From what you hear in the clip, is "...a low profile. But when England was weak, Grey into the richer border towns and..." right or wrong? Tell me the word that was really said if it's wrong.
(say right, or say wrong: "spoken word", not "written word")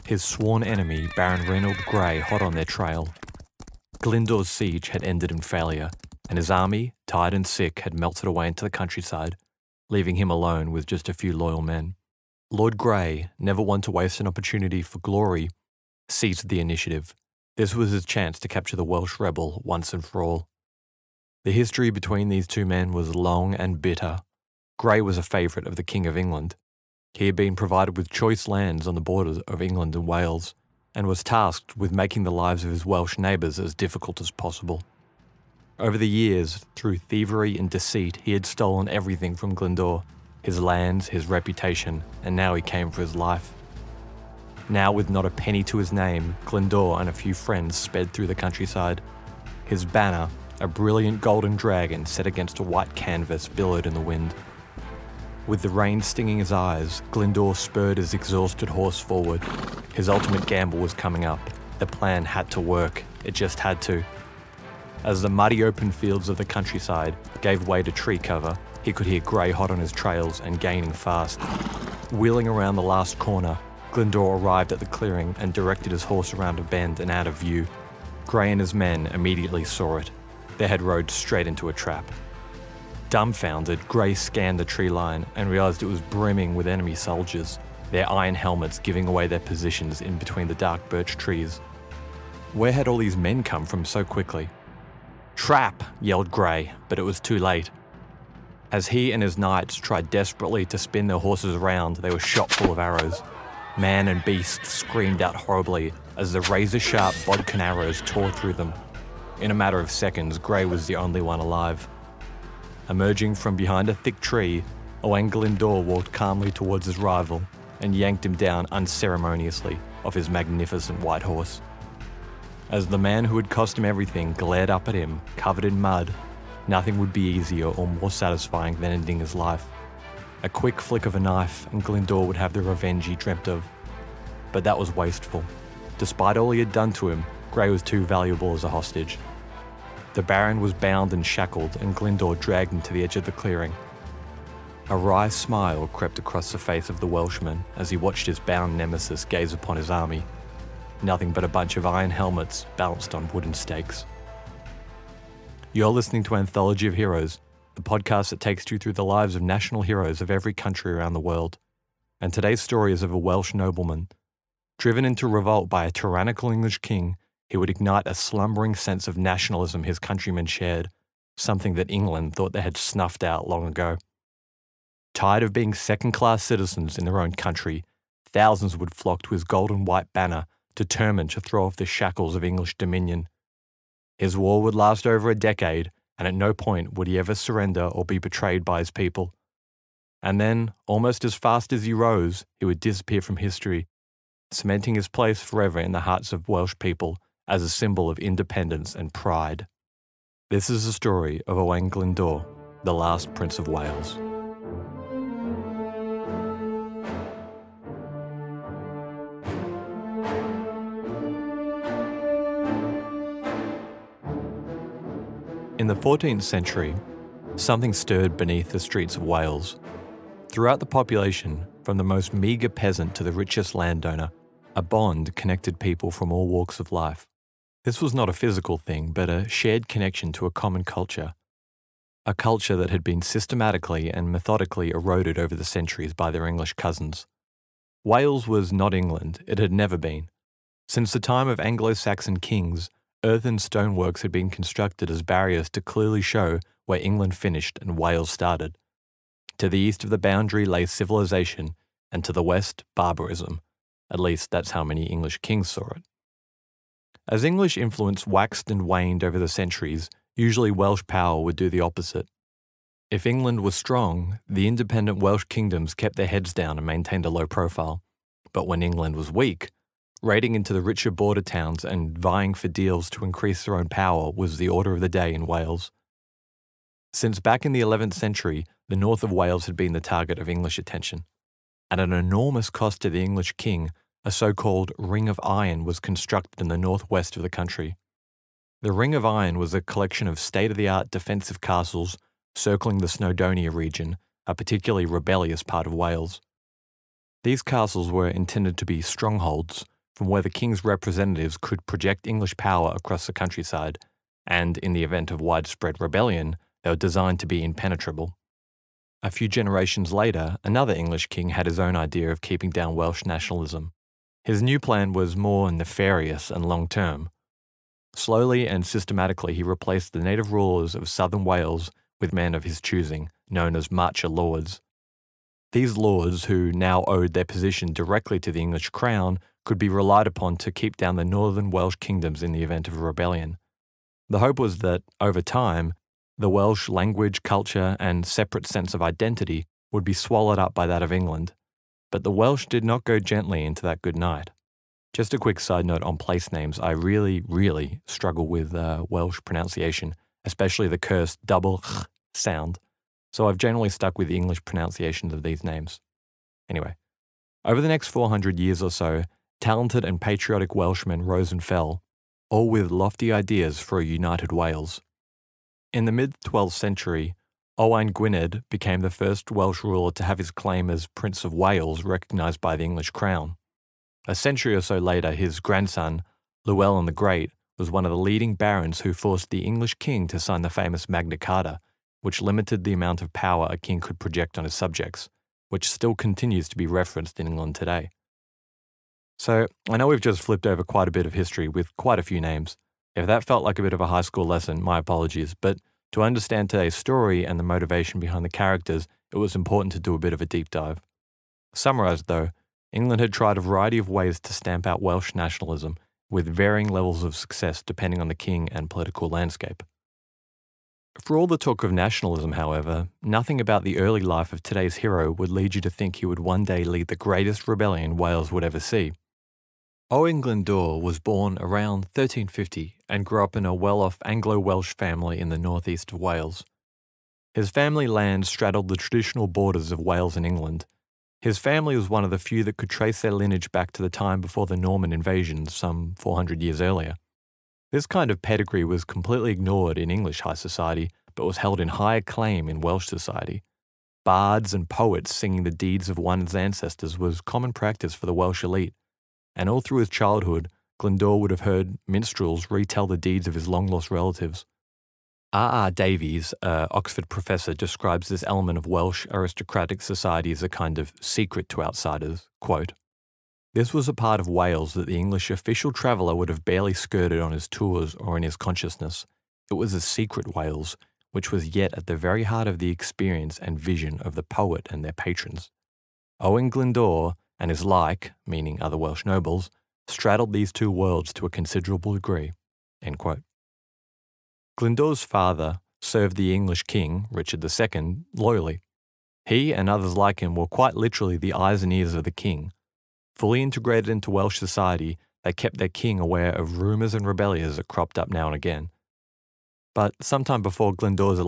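wrong: "Raiding", not "Grey".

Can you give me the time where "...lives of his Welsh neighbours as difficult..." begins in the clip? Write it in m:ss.
0:32.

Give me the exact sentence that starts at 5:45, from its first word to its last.
Just a quick side note on place names.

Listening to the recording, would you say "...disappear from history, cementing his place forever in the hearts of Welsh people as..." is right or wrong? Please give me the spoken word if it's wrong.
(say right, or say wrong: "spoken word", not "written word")
right.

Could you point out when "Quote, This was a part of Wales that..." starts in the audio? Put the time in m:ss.
7:42.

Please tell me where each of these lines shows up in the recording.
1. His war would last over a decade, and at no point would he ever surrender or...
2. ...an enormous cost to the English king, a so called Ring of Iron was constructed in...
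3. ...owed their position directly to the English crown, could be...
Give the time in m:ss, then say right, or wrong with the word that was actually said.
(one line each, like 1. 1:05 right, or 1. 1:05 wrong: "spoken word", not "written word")
1. 3:04 right
2. 4:41 right
3. 5:27 right.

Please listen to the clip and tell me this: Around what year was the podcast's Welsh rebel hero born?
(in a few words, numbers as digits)
1350.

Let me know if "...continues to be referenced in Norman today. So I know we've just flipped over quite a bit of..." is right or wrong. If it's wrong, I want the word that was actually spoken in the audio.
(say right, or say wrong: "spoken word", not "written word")
wrong: "England", not "Norman".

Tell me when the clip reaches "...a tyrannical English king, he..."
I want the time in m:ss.
2:45.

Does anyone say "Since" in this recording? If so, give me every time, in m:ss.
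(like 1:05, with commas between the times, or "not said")
4:00, 4:37.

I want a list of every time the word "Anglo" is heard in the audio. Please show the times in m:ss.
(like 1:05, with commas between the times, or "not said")
4:01, 7:04.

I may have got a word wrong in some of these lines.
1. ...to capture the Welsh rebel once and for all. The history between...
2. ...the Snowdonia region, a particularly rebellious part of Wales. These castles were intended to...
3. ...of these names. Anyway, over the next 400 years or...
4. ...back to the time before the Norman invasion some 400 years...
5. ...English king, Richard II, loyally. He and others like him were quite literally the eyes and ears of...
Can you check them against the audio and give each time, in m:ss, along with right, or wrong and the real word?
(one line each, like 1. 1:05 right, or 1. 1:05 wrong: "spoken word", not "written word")
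1. 0:18 right
2. 4:52 right
3. 5:55 right
4. 7:13 right
5. 8:06 right.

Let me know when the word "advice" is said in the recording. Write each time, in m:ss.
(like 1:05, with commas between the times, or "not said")
not said.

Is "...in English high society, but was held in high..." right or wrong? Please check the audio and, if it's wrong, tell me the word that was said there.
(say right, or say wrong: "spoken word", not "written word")
right.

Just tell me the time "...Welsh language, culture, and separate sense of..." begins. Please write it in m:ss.
5:36.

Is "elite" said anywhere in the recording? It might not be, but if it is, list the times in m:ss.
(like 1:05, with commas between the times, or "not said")
7:28.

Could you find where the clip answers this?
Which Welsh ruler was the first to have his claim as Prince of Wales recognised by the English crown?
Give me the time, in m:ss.
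6:07.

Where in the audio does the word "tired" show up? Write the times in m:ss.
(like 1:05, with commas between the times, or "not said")
0:07, 2:55.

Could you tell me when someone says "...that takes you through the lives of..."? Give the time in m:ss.
2:38.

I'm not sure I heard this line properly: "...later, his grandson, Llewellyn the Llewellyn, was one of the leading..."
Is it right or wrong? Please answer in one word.
wrong.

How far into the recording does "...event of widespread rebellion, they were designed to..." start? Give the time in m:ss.
5:05.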